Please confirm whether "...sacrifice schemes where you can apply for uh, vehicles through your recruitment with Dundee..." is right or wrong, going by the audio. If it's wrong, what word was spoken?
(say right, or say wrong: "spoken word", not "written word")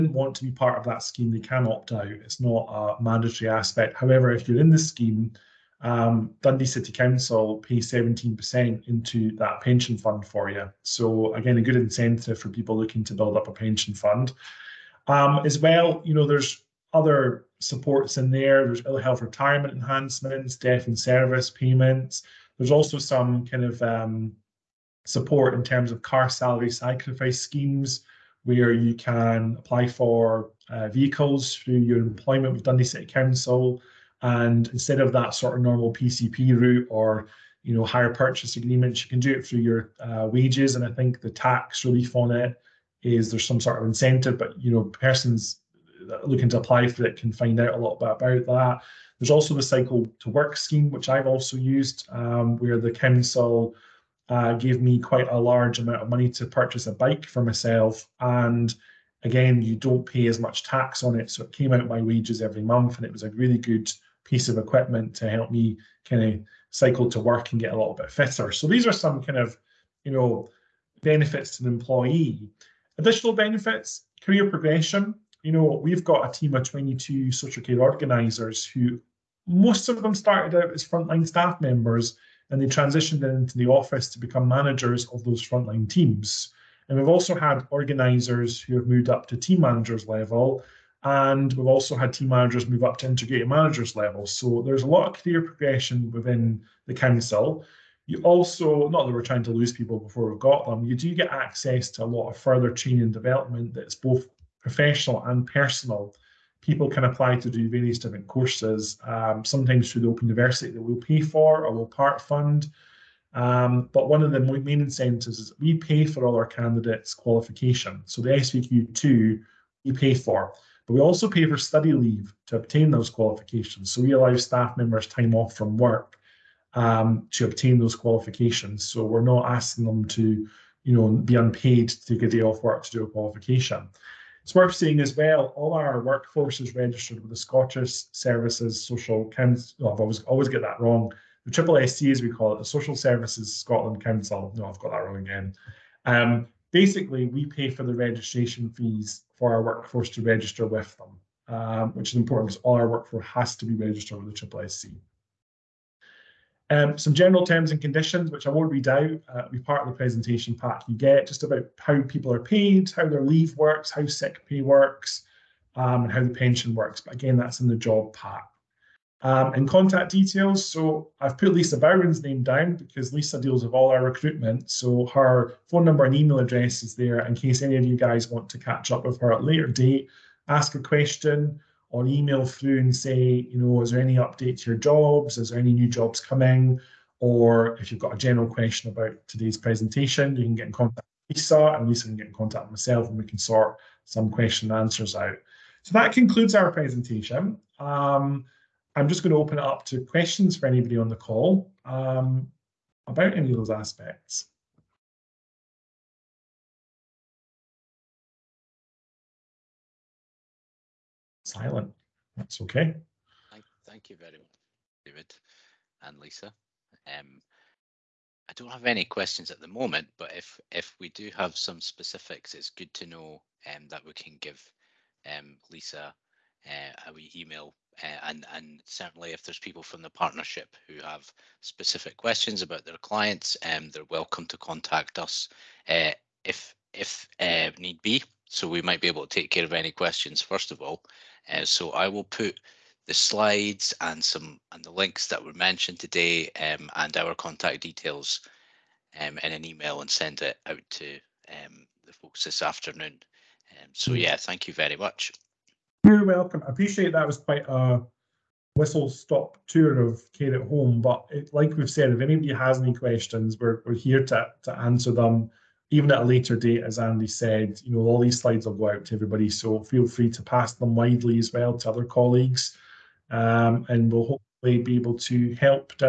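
wrong: "employment", not "recruitment".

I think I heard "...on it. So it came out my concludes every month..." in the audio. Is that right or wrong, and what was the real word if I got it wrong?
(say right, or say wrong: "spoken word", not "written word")
wrong: "wages", not "concludes".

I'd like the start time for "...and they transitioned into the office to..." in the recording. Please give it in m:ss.
1:22.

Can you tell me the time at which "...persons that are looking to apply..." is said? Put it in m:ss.
0:44.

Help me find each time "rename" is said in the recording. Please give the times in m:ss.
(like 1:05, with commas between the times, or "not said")
not said.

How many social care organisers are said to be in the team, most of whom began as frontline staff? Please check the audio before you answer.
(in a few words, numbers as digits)
22.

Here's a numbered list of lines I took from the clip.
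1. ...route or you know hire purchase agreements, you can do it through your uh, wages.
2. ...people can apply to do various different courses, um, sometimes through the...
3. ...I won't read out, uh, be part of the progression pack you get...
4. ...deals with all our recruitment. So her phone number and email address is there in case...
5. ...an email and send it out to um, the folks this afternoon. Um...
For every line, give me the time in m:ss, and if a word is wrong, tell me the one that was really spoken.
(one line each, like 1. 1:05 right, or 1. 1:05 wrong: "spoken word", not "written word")
1. 0:36 right
2. 1:46 right
3. 2:38 wrong: "presentation", not "progression"
4. 2:53 right
5. 4:09 right.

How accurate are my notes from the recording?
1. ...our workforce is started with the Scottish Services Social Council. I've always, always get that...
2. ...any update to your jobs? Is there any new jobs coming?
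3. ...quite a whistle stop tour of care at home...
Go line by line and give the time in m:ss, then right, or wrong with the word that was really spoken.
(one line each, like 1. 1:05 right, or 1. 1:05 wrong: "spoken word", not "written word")
1. 2:15 wrong: "registered", not "started"
2. 3:04 right
3. 4:17 right.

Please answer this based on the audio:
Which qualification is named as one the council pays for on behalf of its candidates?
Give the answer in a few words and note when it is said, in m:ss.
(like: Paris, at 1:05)
SVQ2, at 1:58.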